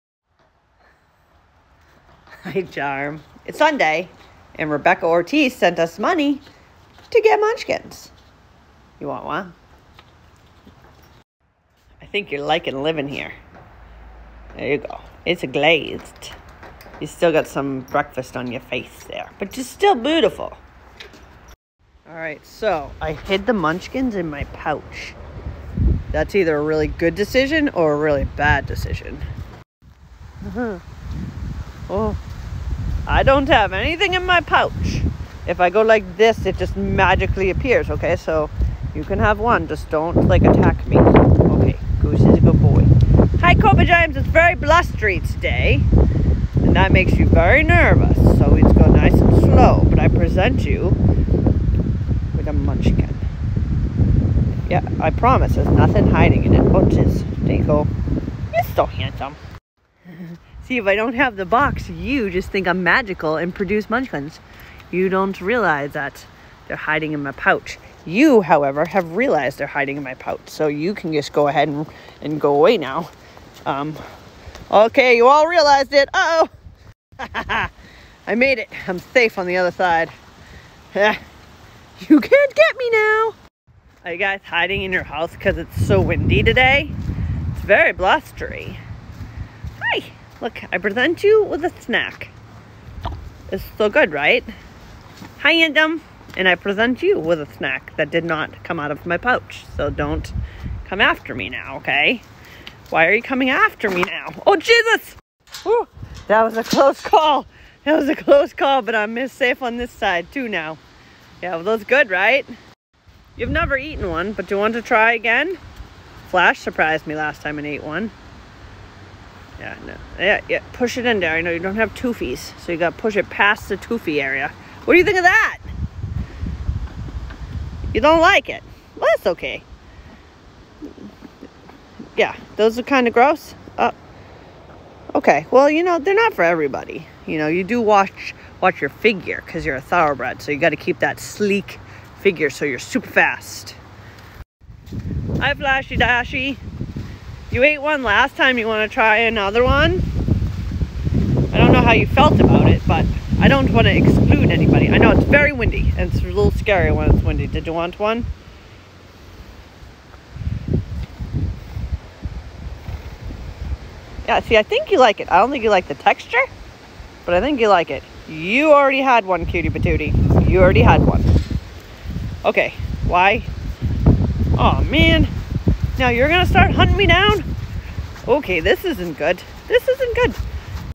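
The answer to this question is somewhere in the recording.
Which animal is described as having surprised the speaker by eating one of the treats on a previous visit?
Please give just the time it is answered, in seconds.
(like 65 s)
116 s.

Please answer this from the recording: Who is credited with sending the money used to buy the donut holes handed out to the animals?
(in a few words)
Rebecca Ortiz.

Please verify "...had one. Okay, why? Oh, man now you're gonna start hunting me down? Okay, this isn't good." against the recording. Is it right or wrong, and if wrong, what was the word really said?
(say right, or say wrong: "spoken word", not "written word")
right.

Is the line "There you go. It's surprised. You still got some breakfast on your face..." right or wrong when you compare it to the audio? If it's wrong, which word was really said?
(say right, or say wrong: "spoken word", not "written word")
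wrong: "glazed", not "surprised".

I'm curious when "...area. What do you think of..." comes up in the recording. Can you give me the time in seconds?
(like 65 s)
124 s.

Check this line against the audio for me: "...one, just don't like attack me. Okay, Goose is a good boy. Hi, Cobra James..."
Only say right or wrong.
right.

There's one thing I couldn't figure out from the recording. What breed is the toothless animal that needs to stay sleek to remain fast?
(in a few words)
Thoroughbred.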